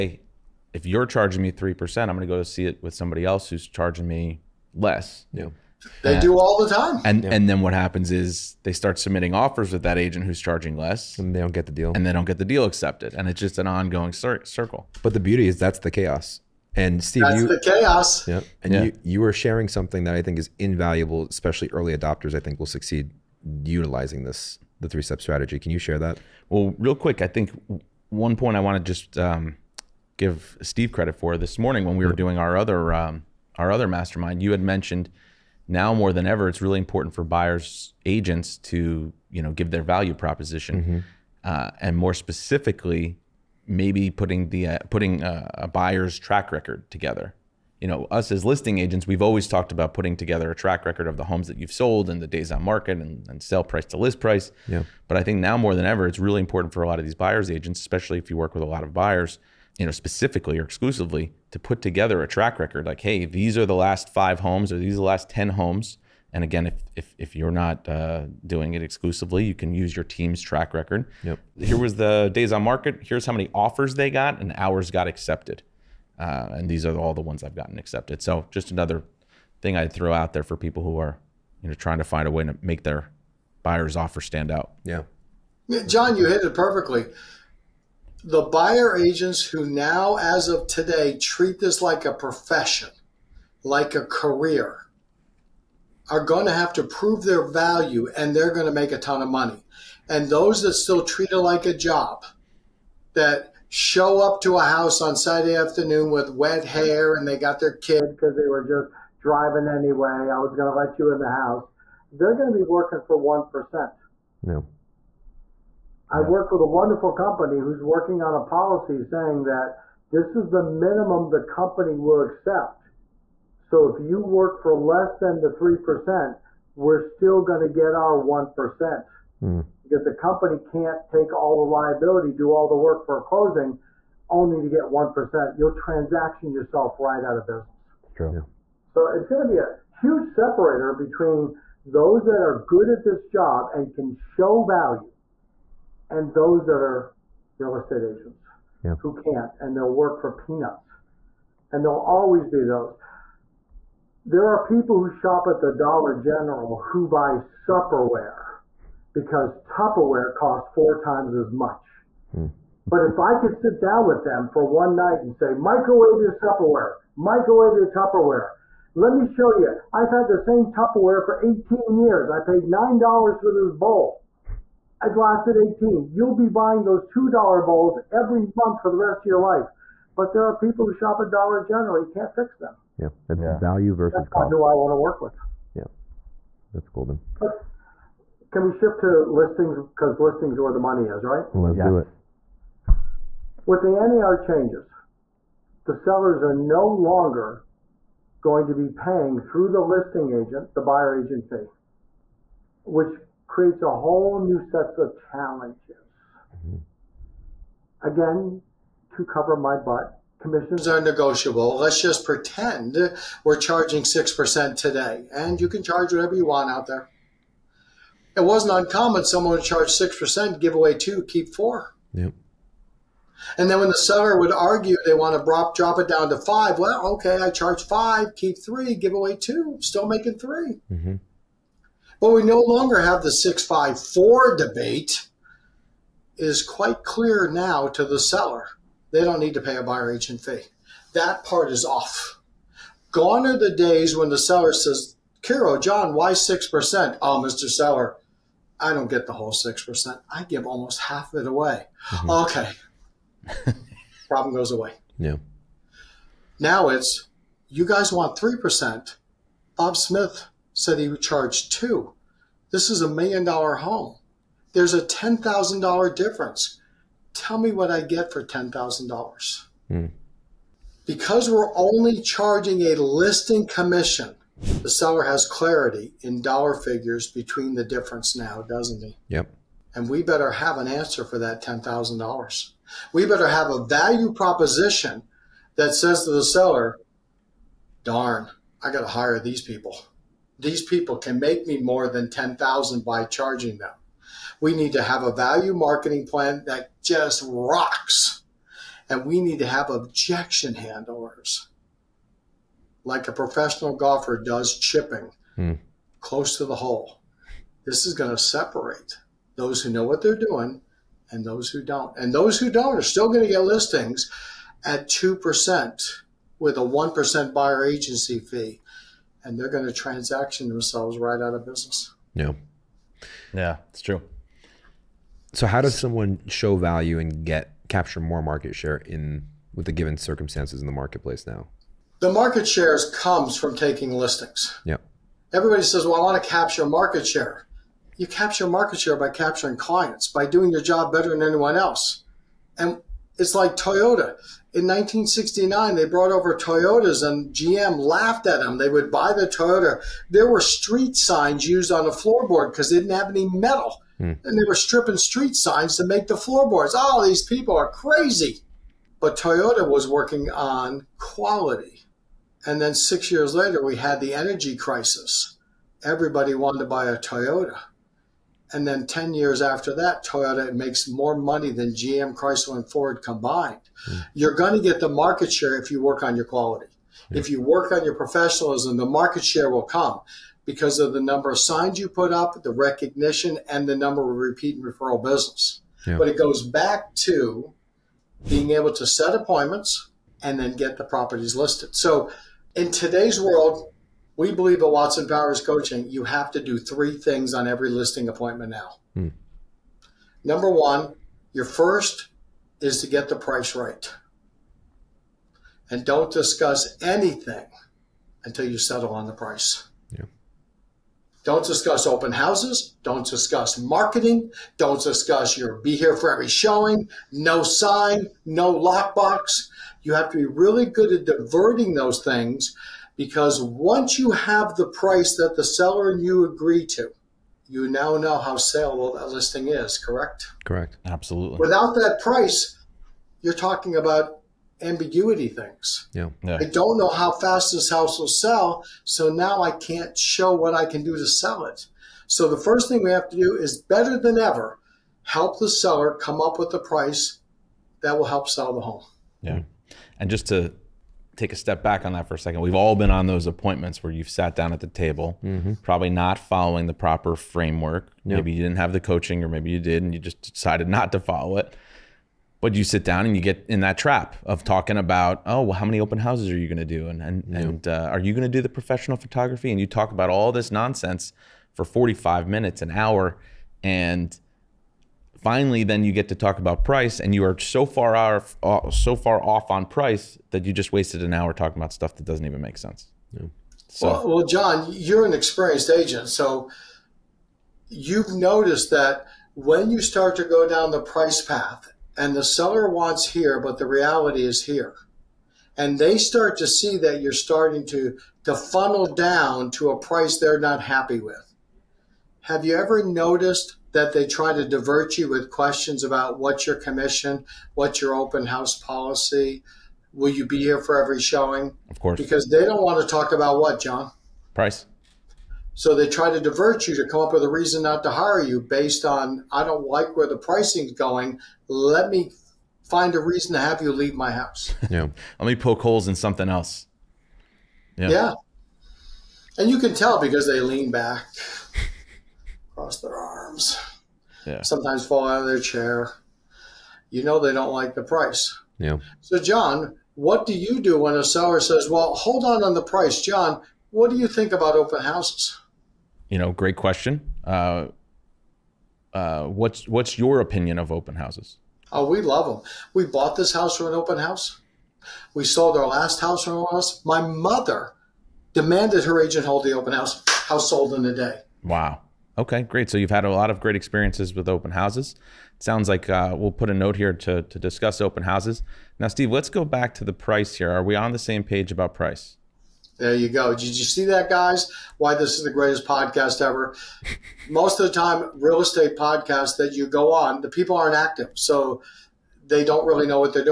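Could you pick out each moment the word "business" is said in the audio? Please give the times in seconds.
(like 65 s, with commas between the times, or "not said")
137 s, 321 s, 385 s.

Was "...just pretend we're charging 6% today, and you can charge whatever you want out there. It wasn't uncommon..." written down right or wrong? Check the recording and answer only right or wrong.
right.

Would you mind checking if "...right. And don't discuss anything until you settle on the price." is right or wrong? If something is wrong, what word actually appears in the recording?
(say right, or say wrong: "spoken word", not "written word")
right.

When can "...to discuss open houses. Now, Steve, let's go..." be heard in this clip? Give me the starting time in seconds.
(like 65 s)
567 s.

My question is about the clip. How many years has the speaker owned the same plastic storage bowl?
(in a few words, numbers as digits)
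18.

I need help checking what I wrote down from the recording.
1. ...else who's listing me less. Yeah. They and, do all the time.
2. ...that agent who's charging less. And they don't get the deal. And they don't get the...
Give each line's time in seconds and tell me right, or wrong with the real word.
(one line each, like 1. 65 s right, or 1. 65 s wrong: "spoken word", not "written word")
1. 3 s wrong: "charging", not "listing"
2. 9 s right.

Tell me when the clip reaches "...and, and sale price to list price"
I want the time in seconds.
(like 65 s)
52 s.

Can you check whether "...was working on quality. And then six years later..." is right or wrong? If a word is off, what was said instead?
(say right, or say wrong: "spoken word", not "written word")
right.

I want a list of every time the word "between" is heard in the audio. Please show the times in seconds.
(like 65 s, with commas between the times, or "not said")
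140 s, 277 s.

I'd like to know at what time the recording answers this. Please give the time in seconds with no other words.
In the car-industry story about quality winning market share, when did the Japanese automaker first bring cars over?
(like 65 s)
344 s.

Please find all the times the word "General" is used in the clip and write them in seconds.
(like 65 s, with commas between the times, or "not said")
156 s, 181 s.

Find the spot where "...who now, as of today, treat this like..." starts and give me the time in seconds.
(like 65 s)
89 s.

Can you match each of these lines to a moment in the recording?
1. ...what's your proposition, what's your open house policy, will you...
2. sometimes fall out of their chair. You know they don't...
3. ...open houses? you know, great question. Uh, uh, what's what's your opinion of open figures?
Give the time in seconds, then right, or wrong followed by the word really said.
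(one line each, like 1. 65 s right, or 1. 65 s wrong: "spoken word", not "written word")
1. 506 s wrong: "commission", not "proposition"
2. 534 s right
3. 544 s wrong: "houses", not "figures".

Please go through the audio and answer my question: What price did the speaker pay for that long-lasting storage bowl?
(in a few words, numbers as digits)
$9.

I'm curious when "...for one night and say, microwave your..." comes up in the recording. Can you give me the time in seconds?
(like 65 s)
164 s.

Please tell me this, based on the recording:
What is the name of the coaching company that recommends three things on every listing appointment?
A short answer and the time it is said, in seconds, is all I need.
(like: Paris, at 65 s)
Watson Powers Coaching, at 394 s.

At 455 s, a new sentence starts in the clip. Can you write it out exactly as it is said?
probably not following the proper framework.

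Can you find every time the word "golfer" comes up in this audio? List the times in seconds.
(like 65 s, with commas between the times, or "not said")
303 s.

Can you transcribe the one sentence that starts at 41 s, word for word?
uh, and more specifically, maybe putting the uh, putting a, uh, a buyer's track record together.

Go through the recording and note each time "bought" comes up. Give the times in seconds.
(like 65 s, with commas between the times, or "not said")
553 s.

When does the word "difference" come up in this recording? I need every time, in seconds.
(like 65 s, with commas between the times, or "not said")
266 s, 277 s.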